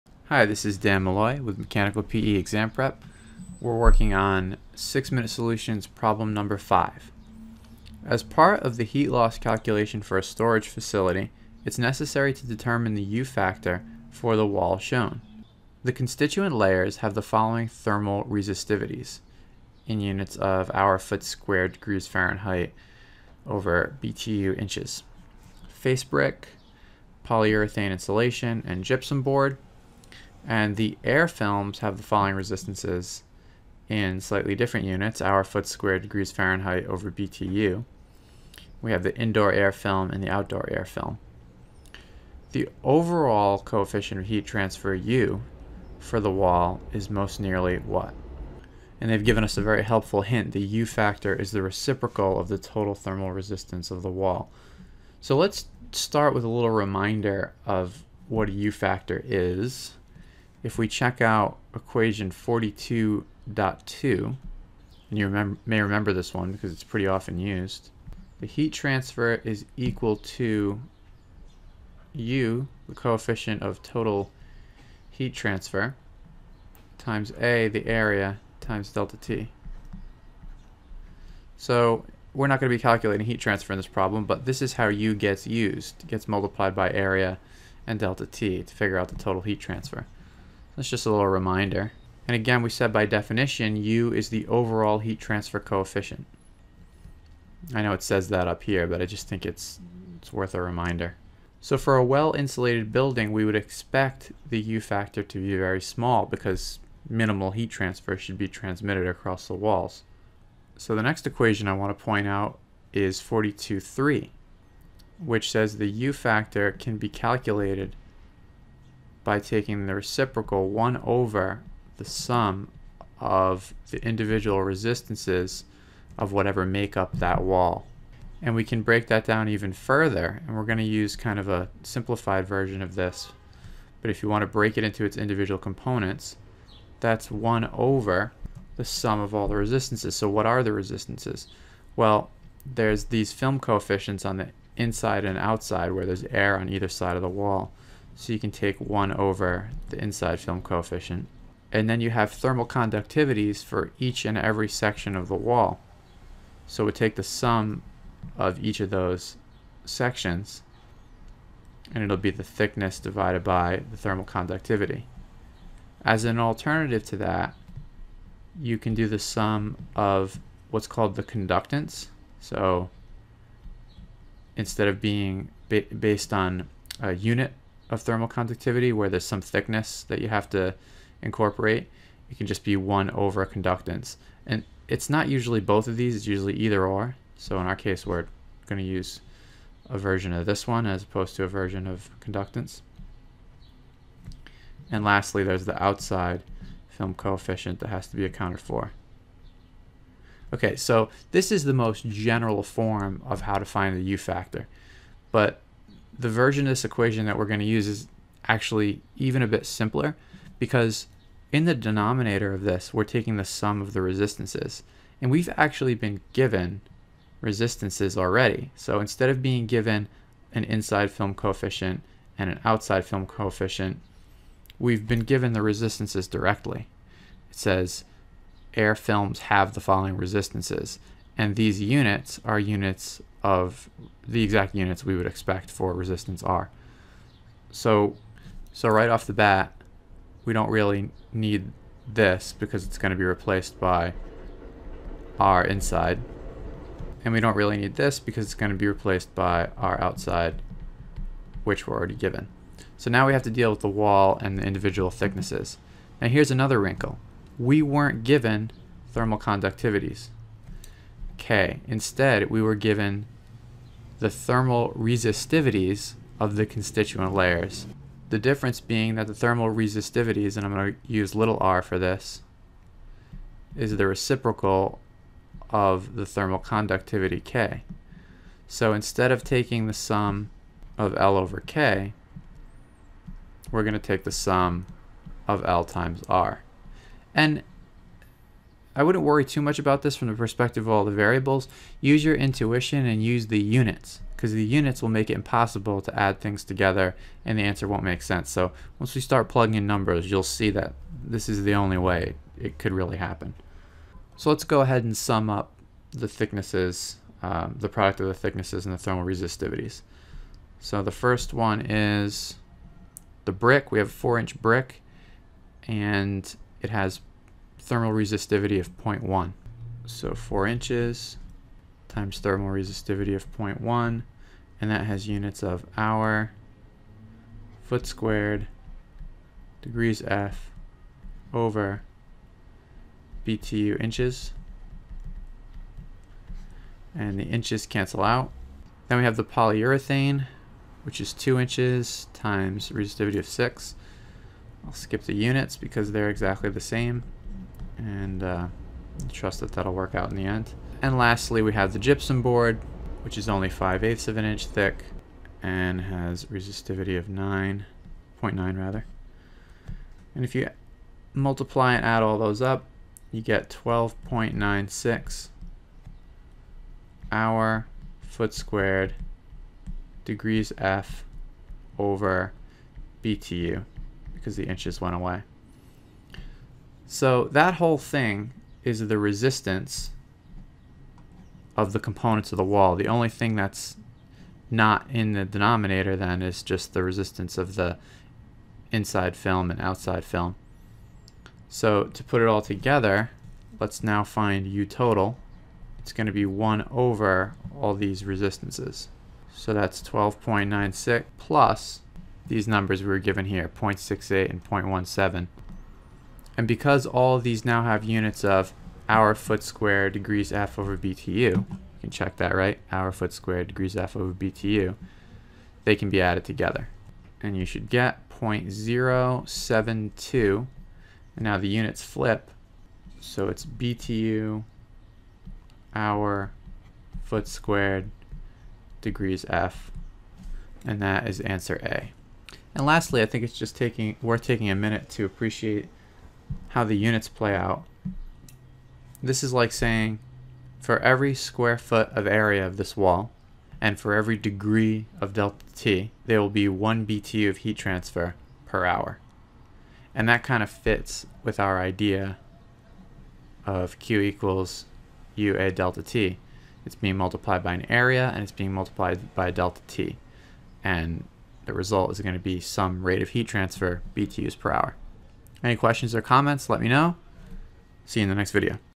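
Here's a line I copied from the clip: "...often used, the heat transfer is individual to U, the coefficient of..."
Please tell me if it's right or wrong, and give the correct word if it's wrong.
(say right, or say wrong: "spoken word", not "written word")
wrong: "equal", not "individual".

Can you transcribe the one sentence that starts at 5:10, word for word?
So the first one is the brick.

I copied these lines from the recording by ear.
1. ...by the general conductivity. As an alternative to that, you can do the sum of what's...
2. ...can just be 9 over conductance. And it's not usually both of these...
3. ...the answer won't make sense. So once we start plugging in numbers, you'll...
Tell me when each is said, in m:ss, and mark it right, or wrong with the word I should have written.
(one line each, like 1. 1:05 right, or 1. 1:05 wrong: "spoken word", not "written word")
1. 2:43 wrong: "thermal", not "general"
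2. 3:02 wrong: "1", not "9"
3. 4:57 right.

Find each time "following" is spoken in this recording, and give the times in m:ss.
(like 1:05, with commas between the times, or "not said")
0:17, 0:32, 3:49.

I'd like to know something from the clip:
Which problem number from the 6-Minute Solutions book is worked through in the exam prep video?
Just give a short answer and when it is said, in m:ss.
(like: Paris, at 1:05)
5, at 0:05.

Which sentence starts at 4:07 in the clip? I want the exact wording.
And we don't really need this because it's going to be replaced by R outside, which we're already given.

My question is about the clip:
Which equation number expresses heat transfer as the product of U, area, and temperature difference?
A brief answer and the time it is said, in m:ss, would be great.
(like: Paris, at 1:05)
42.2, at 1:01.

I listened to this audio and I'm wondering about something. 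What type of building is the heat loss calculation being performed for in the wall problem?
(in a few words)
A storage facility.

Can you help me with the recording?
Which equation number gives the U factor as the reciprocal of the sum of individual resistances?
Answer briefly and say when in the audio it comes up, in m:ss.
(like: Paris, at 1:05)
42.3, at 1:53.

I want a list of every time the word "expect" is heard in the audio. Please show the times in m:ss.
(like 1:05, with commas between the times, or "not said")
1:43, 3:55.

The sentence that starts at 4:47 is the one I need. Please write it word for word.
And I wouldn't worry too much about this from the perspective of all the variables.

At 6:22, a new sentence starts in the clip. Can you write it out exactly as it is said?
The only thing that's not in the denominator then is just the resistance of the inside film and outside film.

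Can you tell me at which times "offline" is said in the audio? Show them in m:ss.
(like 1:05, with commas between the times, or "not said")
not said.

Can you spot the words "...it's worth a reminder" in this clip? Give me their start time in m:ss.
1:40.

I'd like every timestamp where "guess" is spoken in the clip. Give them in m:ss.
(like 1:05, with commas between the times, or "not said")
not said.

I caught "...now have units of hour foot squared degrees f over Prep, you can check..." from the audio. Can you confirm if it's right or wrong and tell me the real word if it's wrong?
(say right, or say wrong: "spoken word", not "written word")
wrong: "BTU", not "Prep".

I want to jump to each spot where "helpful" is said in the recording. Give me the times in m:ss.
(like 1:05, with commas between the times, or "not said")
0:49.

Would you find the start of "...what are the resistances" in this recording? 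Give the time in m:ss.
2:20.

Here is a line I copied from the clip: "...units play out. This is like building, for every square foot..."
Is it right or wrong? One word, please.
wrong.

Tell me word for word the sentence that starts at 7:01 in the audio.
And now the units flip, so it's BTU hour foot squared degrees F, and that is answer A.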